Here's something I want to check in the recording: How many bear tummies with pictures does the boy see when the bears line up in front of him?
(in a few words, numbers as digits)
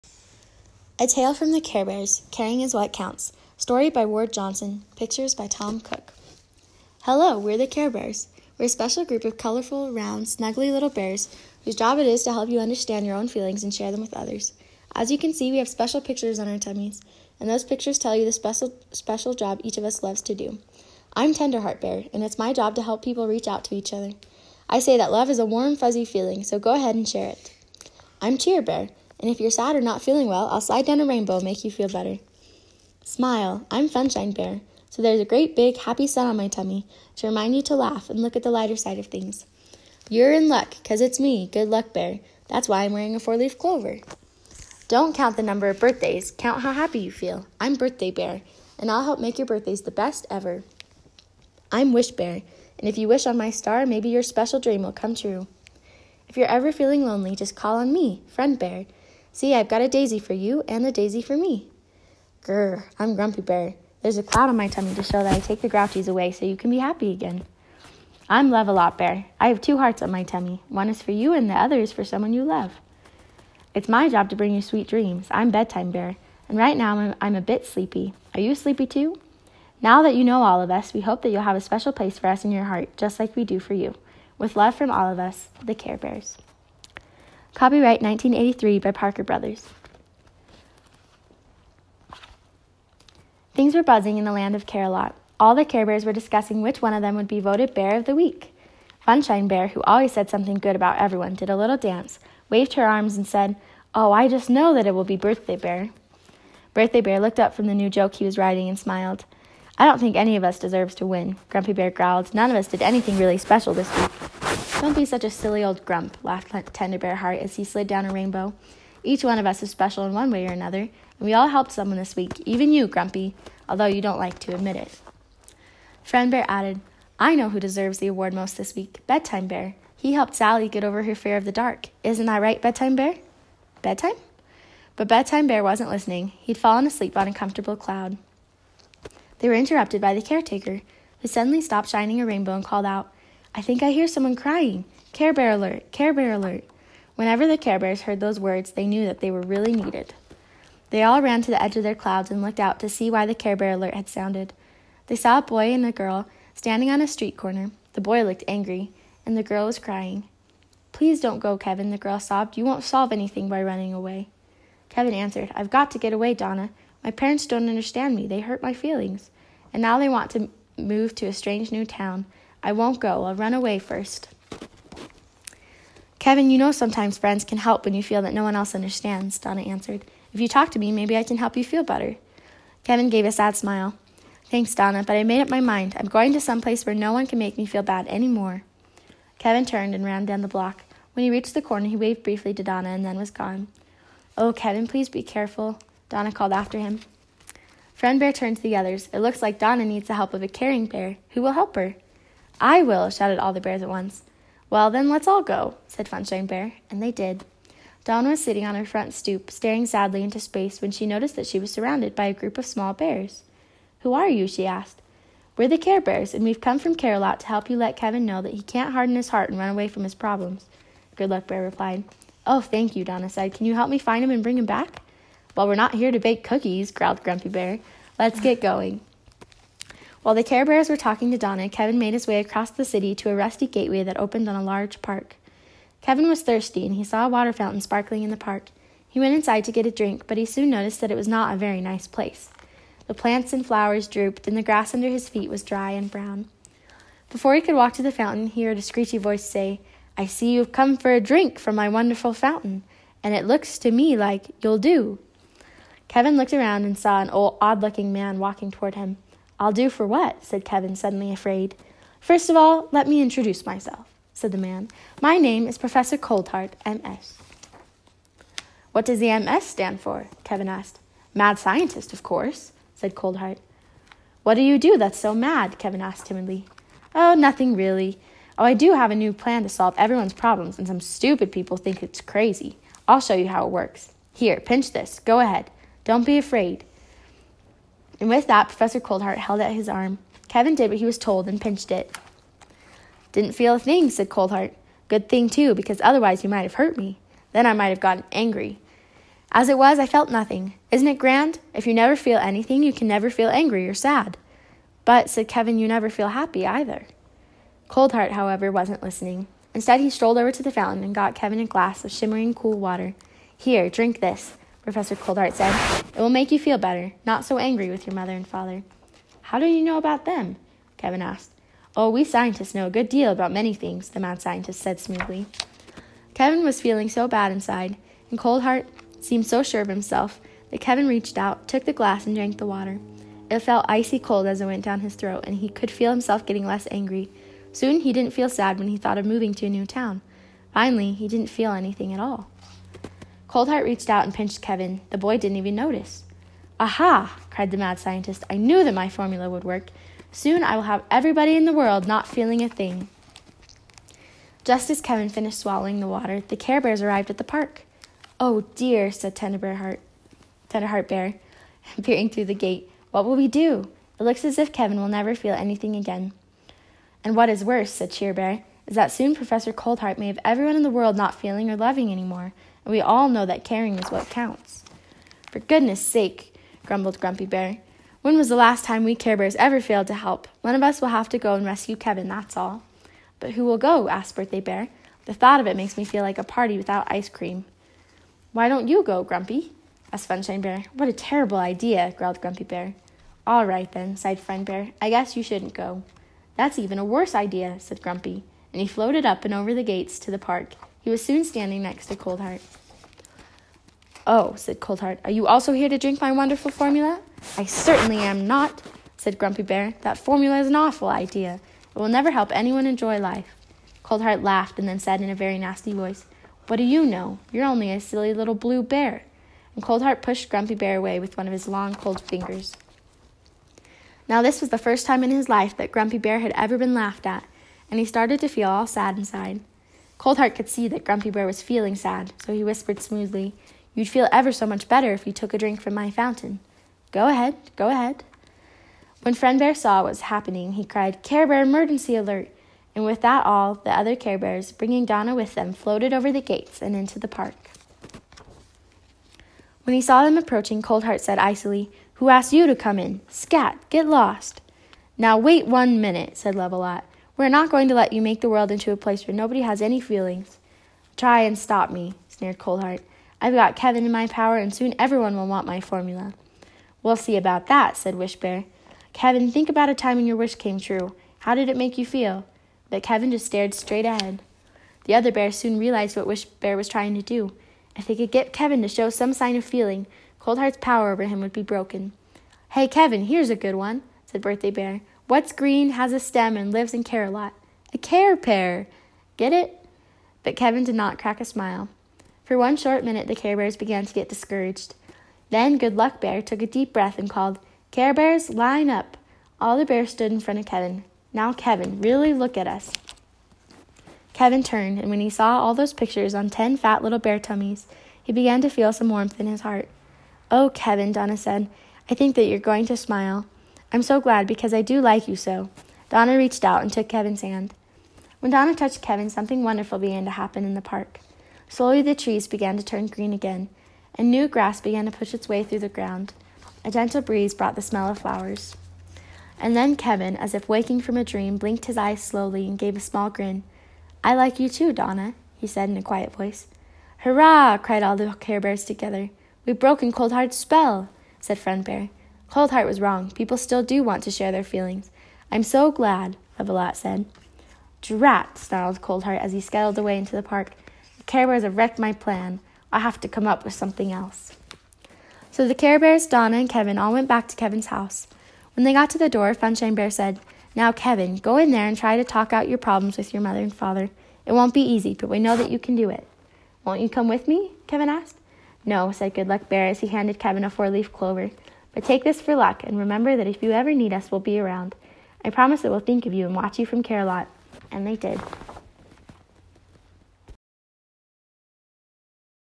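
10.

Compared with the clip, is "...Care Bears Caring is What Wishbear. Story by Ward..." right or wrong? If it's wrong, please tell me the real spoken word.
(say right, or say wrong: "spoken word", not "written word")
wrong: "Counts", not "Wishbear".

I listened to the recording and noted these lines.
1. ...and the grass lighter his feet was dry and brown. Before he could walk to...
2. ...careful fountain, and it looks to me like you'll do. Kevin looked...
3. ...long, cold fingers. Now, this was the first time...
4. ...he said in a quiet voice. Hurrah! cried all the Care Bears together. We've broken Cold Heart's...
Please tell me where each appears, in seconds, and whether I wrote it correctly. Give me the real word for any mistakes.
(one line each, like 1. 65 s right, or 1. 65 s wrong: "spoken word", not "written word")
1. 244 s wrong: "under", not "lighter"
2. 251 s wrong: "wonderful", not "careful"
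3. 421 s right
4. 535 s right.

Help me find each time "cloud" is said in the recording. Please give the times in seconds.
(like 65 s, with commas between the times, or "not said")
64 s, 137 s, 151 s.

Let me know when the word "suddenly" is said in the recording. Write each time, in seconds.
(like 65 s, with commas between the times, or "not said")
141 s, 260 s.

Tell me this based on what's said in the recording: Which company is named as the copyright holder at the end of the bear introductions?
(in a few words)
Parker Brothers.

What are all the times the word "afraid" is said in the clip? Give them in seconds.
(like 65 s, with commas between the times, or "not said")
261 s, 286 s.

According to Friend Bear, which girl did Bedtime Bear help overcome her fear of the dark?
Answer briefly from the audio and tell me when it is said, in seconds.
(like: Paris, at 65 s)
Sally, at 130 s.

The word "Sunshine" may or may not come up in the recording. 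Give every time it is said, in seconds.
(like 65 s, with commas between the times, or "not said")
33 s, 390 s, 559 s.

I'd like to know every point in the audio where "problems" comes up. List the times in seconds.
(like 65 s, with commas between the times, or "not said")
220 s, 280 s, 562 s.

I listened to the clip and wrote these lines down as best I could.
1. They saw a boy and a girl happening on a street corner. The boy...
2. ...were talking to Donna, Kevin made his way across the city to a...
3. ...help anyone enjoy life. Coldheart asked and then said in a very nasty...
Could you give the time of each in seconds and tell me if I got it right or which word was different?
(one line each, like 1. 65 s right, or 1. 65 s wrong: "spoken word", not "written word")
1. 155 s wrong: "standing", not "happening"
2. 230 s right
3. 412 s wrong: "laughed", not "asked".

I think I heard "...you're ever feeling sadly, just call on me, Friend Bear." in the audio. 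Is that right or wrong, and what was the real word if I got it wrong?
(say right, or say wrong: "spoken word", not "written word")
wrong: "lonely", not "sadly".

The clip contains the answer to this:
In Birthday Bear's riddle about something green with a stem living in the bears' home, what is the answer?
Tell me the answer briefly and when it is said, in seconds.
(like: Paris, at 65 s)
A care pear, at 487 s.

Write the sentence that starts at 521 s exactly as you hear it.
Slowly, the trees began to turn green again, and new grass began to push its way through the ground.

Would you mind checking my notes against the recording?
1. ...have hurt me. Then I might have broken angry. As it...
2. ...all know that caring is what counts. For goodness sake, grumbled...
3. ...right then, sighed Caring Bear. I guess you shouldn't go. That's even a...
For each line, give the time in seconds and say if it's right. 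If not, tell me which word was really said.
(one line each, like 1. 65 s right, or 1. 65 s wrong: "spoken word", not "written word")
1. 296 s wrong: "gotten", not "broken"
2. 373 s right
3. 393 s wrong: "Friend", not "Caring".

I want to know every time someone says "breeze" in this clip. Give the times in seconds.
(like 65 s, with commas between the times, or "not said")
527 s.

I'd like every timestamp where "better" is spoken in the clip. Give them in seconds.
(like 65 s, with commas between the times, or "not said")
31 s, 181 s, 316 s, 434 s.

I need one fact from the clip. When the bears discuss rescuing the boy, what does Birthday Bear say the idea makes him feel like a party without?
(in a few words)
ice cream.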